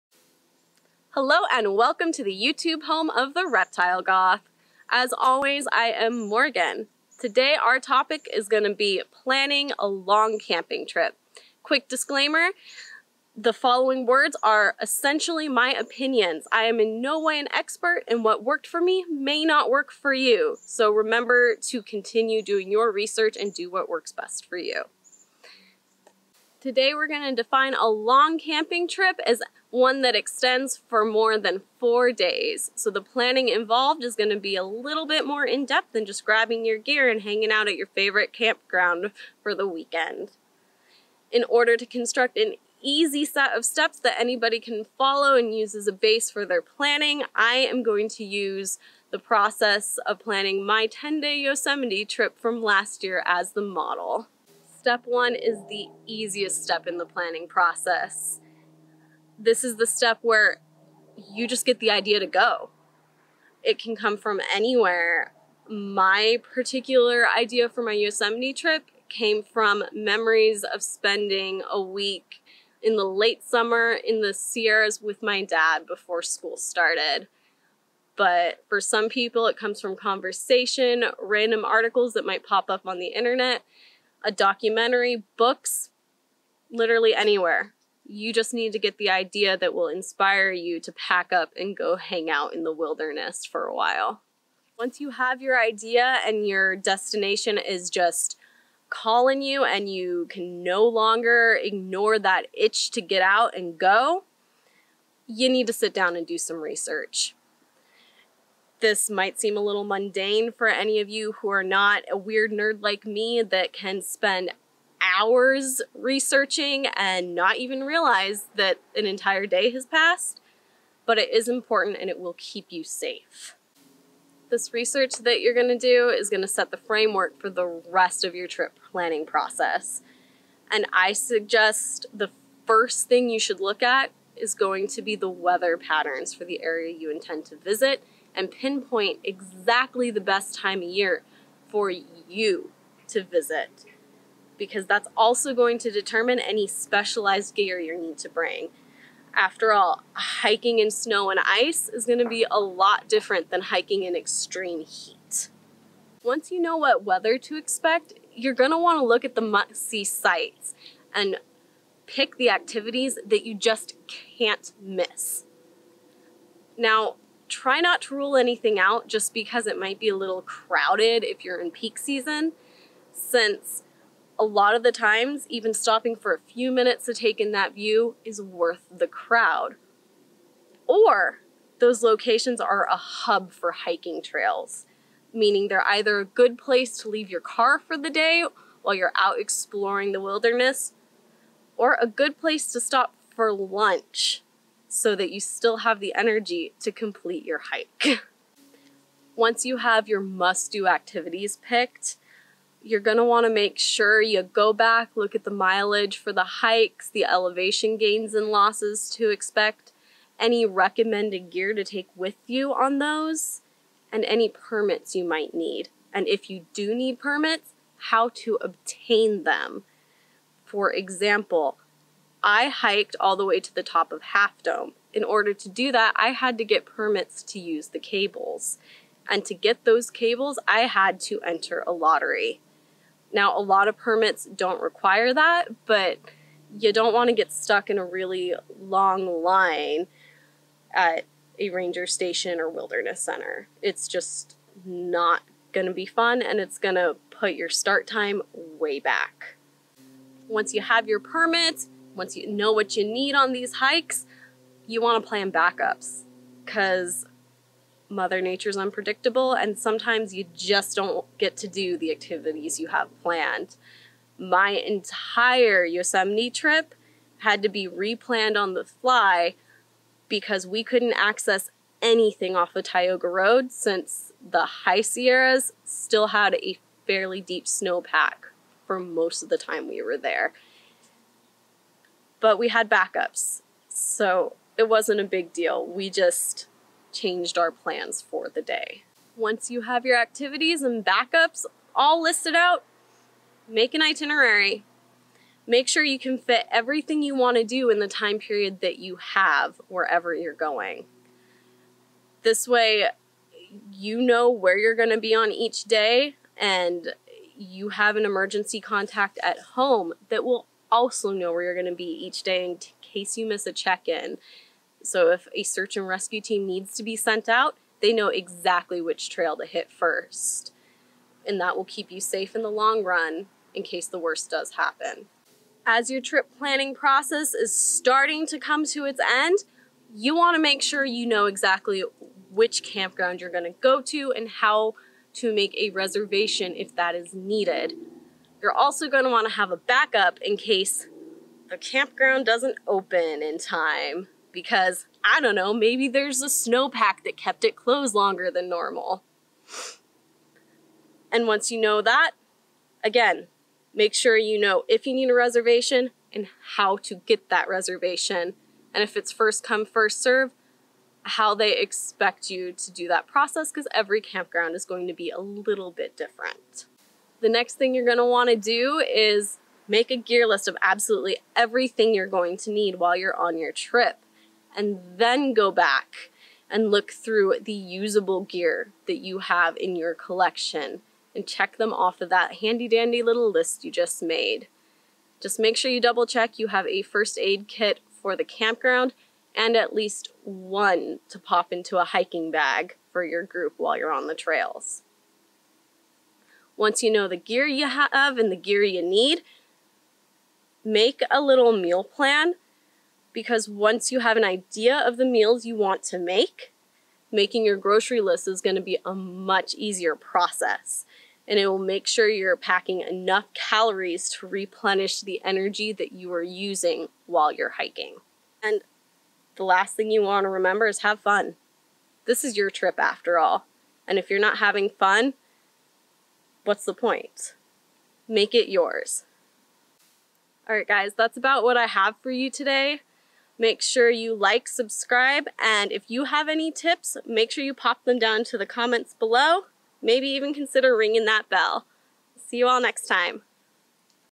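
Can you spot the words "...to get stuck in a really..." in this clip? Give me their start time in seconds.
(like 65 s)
237 s.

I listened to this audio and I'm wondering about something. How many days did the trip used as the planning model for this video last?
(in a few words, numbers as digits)
10.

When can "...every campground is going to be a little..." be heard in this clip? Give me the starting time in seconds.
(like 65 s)
363 s.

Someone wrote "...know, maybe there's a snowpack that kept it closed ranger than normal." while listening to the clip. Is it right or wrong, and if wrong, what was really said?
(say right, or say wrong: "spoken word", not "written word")
wrong: "longer", not "ranger".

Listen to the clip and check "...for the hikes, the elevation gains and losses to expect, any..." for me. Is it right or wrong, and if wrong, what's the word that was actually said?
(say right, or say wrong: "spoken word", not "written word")
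right.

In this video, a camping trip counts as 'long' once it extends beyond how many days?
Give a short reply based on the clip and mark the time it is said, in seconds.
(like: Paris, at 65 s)
4, at 31 s.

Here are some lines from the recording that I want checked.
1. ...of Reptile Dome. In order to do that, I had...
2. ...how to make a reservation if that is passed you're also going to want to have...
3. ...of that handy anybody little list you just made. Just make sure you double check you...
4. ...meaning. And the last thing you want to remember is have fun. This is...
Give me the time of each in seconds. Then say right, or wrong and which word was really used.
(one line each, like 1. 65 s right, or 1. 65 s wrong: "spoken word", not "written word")
1. 224 s wrong: "Half", not "Reptile"
2. 334 s wrong: "needed", not "passed"
3. 382 s wrong: "dandy", not "anybody"
4. 417 s wrong: "hiking", not "meaning".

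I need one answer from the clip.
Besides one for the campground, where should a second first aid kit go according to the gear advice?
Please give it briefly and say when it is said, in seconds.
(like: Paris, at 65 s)
A hiking bag, at 392 s.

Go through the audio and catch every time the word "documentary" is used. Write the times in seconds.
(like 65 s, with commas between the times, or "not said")
84 s.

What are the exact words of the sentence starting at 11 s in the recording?
Quick disclaimer, the following words are essentially my opinions.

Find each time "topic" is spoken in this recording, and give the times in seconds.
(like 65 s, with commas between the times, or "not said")
7 s.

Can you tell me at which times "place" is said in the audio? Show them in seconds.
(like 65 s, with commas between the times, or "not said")
186 s, 192 s.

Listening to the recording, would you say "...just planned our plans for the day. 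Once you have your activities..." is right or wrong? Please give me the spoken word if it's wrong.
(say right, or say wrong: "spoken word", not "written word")
wrong: "changed", not "planned".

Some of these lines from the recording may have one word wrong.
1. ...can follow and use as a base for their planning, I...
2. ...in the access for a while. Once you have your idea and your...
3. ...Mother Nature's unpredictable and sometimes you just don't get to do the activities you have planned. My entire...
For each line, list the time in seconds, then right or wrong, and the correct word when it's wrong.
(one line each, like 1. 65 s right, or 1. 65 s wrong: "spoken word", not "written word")
1. 44 s right
2. 92 s wrong: "wilderness", not "access"
3. 258 s right.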